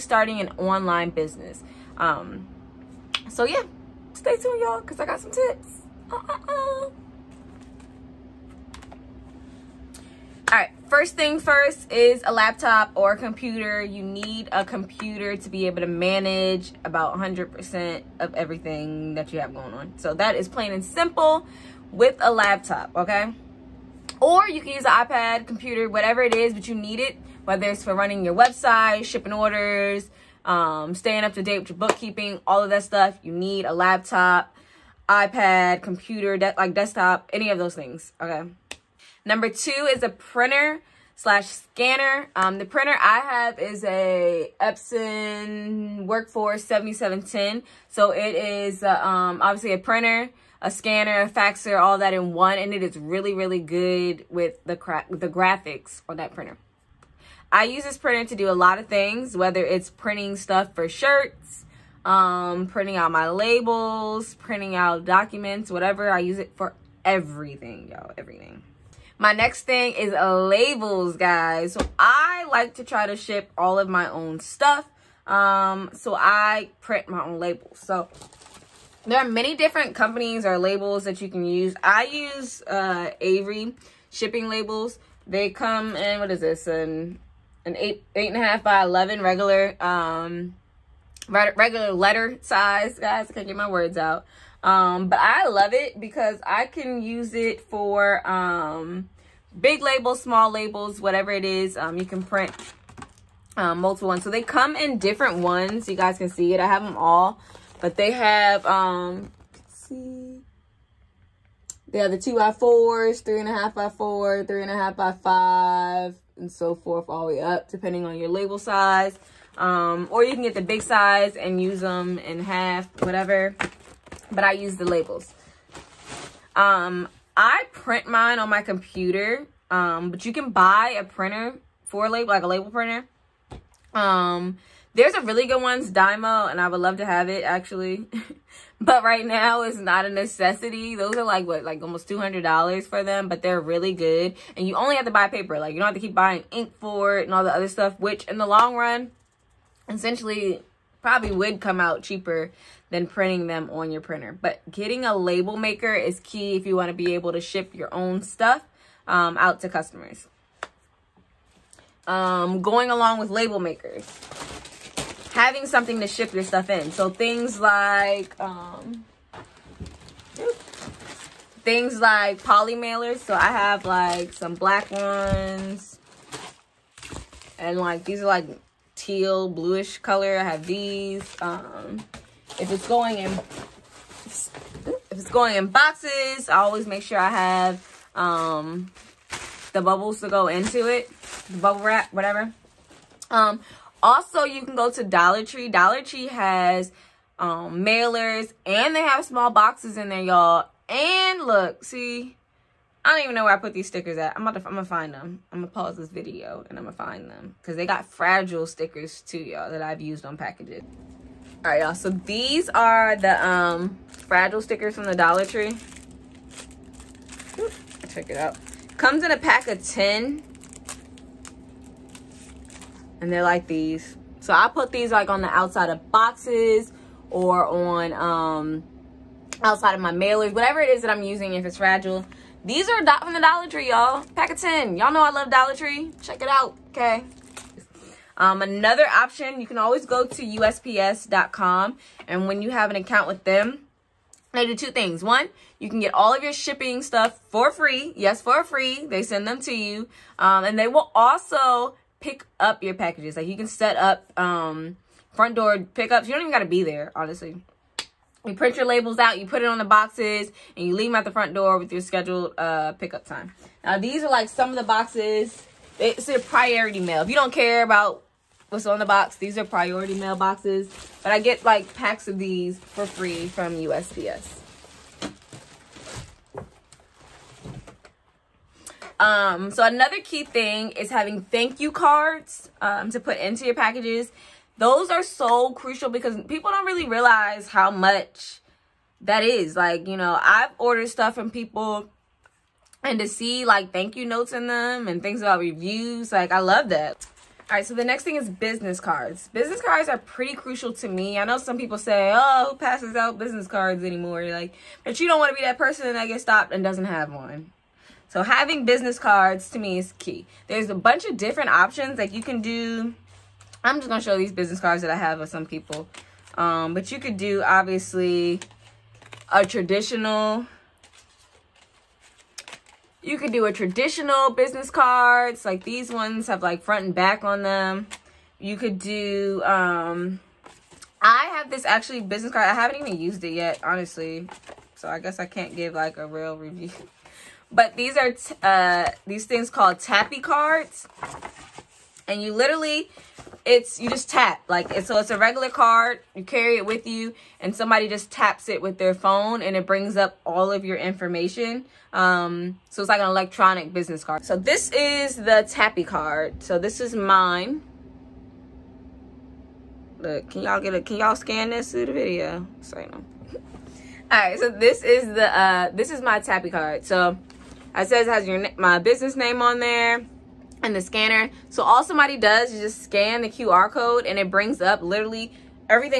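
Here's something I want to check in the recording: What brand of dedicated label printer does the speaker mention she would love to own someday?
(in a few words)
Dymo.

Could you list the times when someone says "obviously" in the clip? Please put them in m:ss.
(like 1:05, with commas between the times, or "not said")
0:49, 5:17.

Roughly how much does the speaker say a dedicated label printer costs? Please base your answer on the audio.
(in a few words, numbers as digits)
almost $200.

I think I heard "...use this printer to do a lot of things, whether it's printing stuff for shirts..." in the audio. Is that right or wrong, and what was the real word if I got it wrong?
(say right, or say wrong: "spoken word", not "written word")
right.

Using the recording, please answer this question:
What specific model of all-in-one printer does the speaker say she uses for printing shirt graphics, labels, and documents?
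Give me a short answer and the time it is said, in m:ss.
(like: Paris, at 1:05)
Epson Workforce 7710, at 0:44.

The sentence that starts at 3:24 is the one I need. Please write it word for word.
I'm about to, I'm gonna find them.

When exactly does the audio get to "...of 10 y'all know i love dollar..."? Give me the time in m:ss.
3:54.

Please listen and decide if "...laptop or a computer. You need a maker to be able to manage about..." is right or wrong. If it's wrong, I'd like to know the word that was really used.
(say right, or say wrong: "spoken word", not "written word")
wrong: "computer", not "maker".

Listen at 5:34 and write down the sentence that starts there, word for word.
So I guess I can't give like a real review.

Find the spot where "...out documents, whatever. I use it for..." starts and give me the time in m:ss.
1:04.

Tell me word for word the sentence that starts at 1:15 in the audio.
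Um, so I print my own labels.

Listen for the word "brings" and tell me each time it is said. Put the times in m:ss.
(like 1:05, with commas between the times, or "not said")
5:49, 6:14.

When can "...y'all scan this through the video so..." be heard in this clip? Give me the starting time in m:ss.
6:01.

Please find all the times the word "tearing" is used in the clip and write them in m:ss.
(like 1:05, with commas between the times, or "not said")
not said.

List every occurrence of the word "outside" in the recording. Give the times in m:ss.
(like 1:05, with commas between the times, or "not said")
3:45, 3:49.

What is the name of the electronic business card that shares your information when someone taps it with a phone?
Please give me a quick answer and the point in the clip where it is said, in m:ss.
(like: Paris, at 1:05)
tappy cards, at 5:39.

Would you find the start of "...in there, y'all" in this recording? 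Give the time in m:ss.
3:19.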